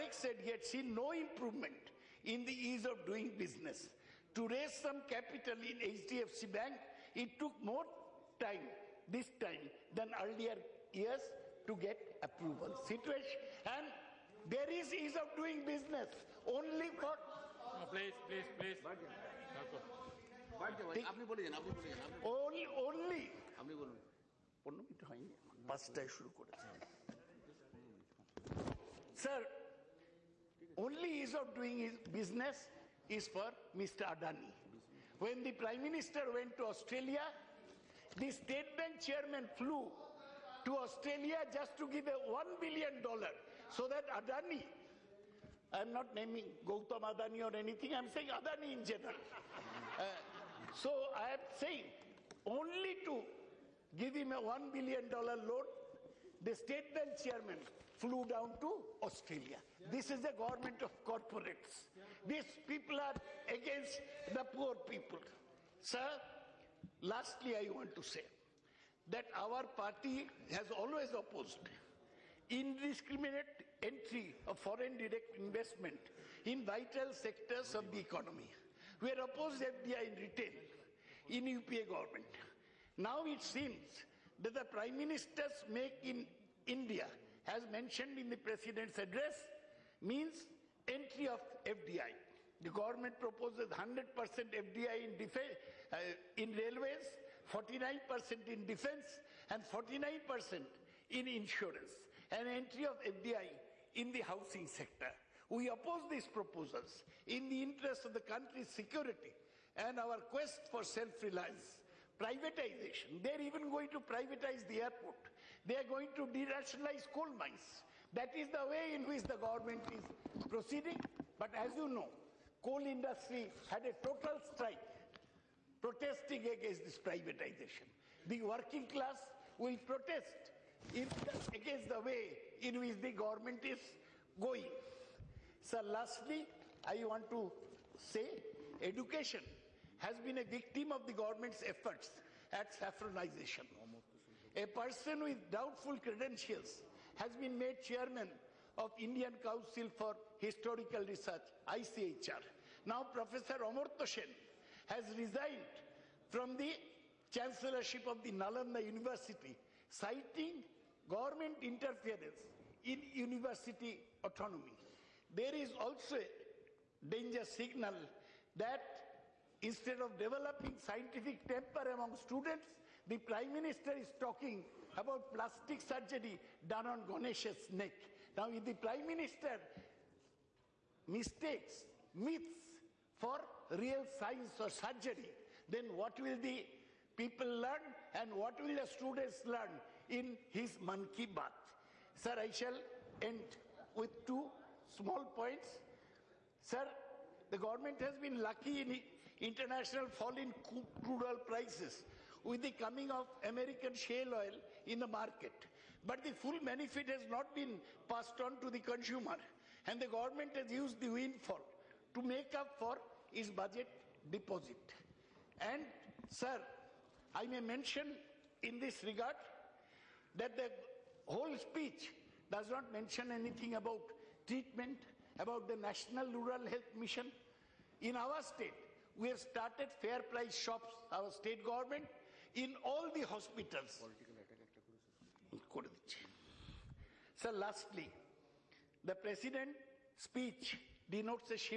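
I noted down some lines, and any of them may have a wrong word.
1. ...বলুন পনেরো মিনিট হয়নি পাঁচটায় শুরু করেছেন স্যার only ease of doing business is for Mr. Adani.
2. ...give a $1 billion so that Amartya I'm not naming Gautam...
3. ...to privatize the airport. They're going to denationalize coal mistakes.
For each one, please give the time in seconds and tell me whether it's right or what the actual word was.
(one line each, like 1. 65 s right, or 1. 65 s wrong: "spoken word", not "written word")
1. 23 s right
2. 41 s wrong: "Adani", not "Amartya"
3. 113 s wrong: "mines", not "mistakes".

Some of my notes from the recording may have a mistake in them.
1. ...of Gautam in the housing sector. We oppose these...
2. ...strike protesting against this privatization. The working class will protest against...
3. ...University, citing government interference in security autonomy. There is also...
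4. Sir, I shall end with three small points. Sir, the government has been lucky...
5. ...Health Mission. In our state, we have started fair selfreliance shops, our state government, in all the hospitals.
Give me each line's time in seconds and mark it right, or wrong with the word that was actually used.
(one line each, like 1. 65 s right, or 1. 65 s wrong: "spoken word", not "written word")
1. 102 s wrong: "FDI", not "Gautam"
2. 124 s right
3. 158 s wrong: "university", not "security"
4. 192 s wrong: "two", not "three"
5. 226 s wrong: "price", not "selfreliance".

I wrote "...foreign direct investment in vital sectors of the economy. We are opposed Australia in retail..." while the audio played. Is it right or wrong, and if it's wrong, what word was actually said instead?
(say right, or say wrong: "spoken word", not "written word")
wrong: "FDI", not "Australia".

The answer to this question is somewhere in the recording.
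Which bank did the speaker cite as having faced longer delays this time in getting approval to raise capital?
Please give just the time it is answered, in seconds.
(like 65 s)
5 s.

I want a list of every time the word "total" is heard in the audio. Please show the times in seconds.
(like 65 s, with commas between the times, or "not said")
123 s.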